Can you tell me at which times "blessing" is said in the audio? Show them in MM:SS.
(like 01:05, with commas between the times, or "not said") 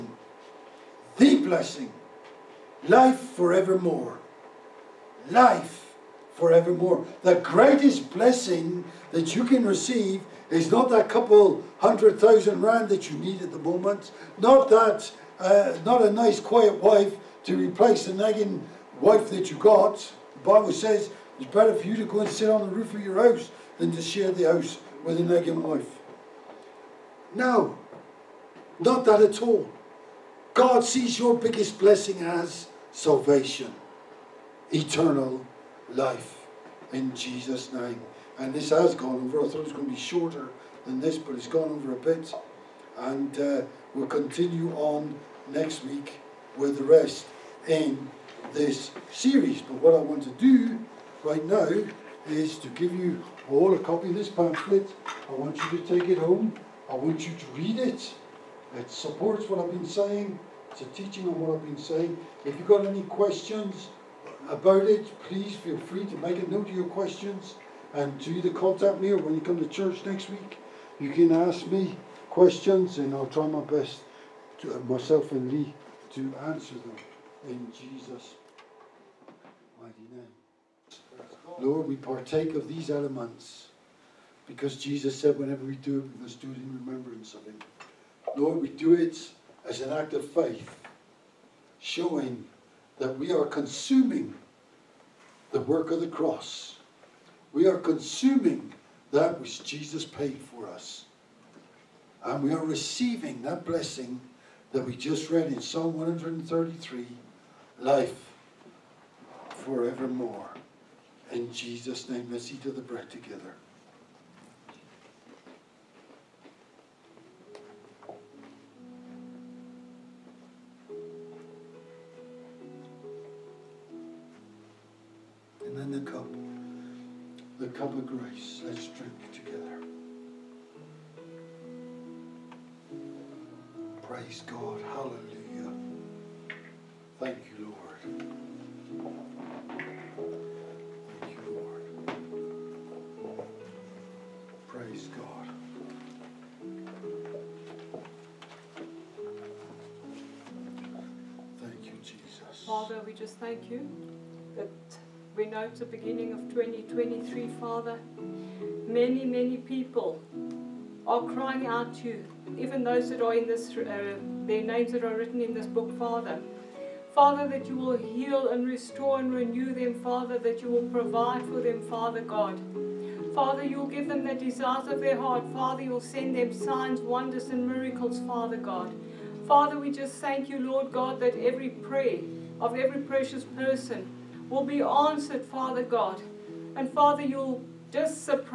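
00:01, 00:08, 00:31, 01:43.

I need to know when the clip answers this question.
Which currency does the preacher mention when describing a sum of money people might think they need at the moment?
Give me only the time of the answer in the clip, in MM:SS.
00:12.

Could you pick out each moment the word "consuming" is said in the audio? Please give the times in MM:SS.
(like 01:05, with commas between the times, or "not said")
01:33, 01:37.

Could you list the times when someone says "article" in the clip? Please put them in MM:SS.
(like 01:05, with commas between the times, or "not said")
not said.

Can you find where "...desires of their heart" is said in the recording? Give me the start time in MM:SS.
02:54.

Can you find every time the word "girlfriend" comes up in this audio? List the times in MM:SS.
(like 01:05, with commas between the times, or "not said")
not said.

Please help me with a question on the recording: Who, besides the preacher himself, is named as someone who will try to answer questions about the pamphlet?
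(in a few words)
Lee.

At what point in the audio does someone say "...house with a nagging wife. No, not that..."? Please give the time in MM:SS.
00:24.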